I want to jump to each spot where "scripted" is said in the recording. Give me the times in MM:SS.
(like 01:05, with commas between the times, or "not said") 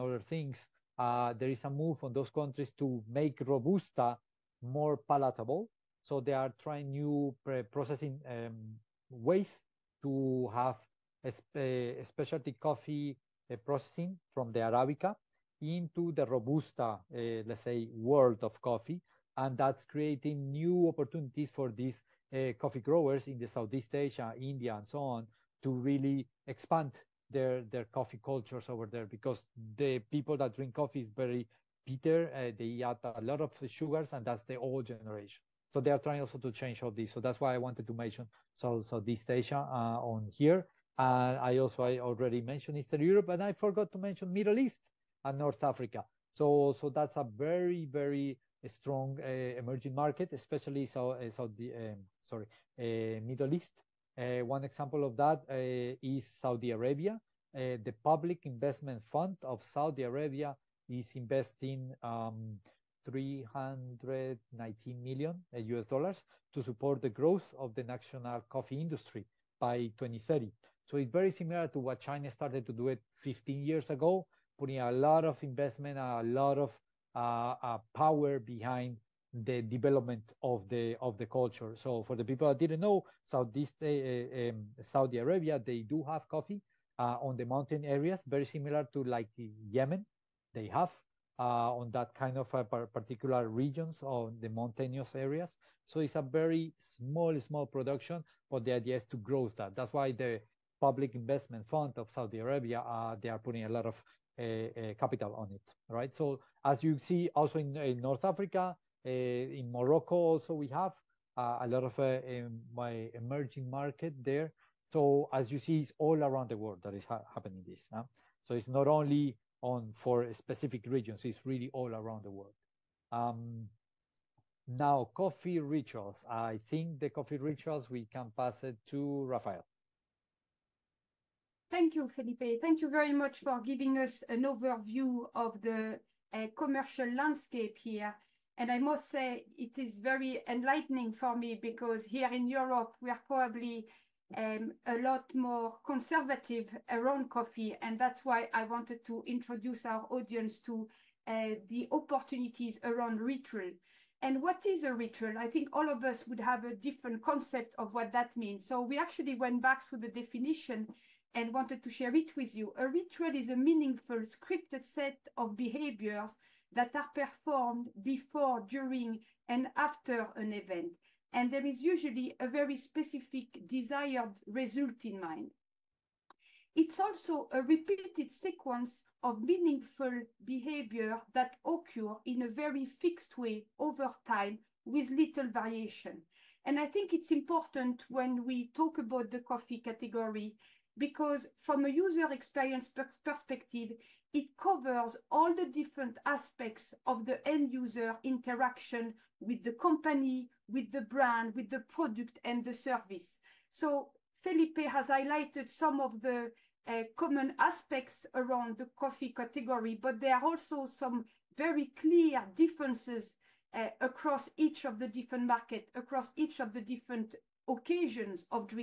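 02:44.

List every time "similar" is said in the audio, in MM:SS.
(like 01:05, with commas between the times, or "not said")
01:11, 01:28.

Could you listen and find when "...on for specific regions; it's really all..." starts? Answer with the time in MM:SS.
01:59.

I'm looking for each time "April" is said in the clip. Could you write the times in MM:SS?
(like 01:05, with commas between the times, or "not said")
not said.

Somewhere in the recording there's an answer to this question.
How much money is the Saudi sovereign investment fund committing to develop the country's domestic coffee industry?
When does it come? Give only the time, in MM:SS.
01:03.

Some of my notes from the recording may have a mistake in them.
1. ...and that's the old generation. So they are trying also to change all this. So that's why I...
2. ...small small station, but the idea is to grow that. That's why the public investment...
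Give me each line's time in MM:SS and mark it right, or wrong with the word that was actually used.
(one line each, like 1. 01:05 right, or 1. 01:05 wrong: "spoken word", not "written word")
1. 00:34 right
2. 01:36 wrong: "production", not "station".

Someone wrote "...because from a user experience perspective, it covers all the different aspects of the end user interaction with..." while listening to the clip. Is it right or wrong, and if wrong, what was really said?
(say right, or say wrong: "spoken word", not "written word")
right.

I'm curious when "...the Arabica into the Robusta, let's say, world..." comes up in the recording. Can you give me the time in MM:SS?
00:14.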